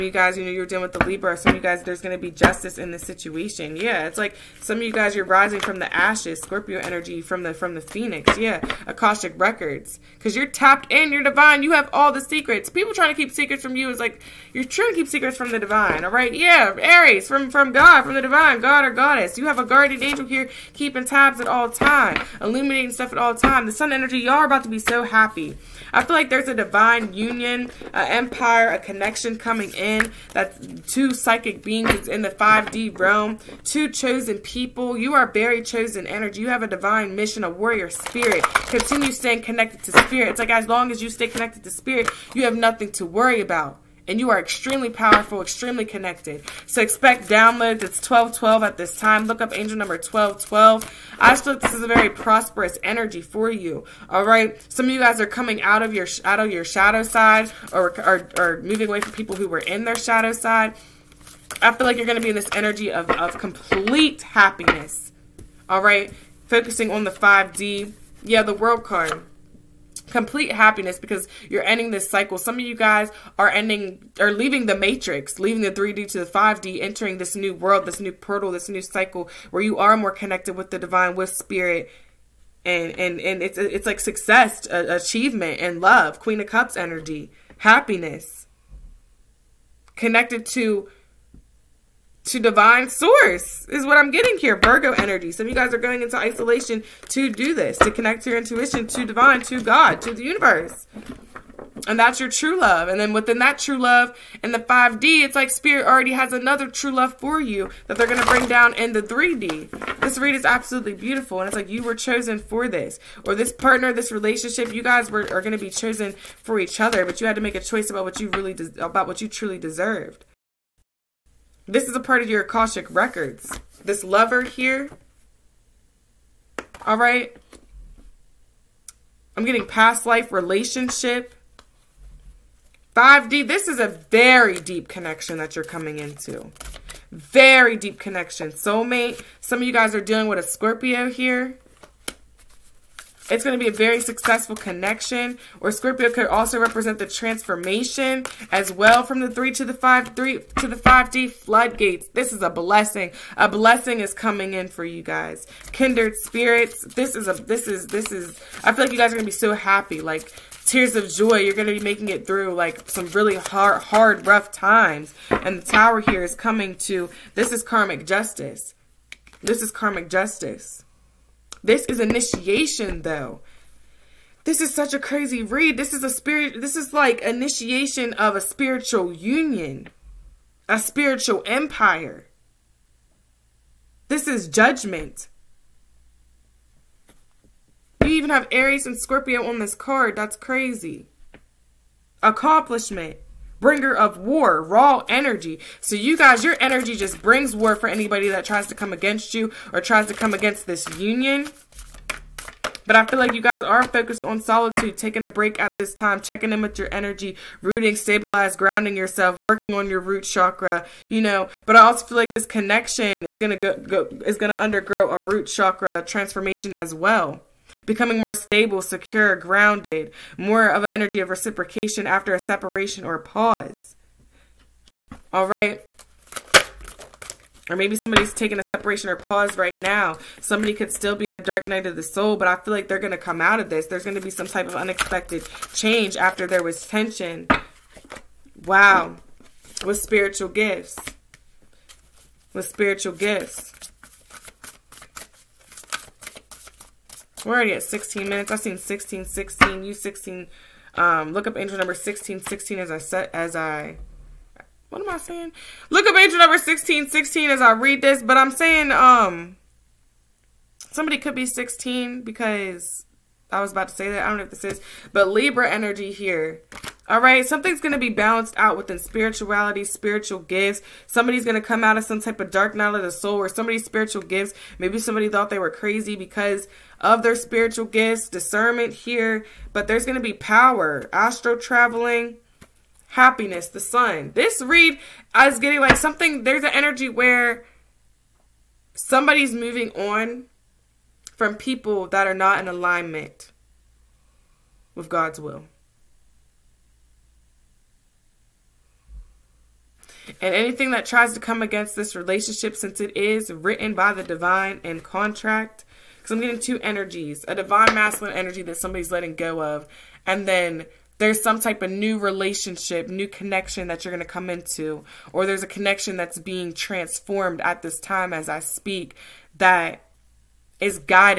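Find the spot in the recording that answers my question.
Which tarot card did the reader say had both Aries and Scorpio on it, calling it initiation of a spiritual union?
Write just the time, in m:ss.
3:04.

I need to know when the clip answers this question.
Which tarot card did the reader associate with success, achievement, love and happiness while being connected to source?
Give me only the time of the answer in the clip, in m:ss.
1:26.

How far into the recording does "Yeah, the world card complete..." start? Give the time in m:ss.
1:08.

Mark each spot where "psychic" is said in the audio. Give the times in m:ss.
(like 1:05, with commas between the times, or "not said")
0:31.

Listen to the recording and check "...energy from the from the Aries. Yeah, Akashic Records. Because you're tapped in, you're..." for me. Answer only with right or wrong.
wrong.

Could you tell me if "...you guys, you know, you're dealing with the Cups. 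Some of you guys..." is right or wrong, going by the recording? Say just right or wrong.
wrong.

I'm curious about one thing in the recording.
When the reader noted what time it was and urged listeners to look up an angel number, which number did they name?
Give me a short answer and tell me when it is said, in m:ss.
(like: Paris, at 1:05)
1212, at 0:47.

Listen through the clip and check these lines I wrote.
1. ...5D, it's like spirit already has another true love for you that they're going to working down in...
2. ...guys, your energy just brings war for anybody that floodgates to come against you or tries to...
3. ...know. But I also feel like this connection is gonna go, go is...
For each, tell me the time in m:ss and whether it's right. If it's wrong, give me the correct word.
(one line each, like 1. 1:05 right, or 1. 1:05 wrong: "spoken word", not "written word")
1. 1:44 wrong: "bring", not "working"
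2. 3:16 wrong: "tries", not "floodgates"
3. 3:31 right.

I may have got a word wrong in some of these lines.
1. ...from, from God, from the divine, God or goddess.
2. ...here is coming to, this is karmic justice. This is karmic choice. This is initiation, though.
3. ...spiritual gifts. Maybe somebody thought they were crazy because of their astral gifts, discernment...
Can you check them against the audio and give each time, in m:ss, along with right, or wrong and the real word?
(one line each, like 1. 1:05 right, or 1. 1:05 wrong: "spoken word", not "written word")
1. 0:17 right
2. 2:45 wrong: "justice", not "choice"
3. 4:33 wrong: "spiritual", not "astral".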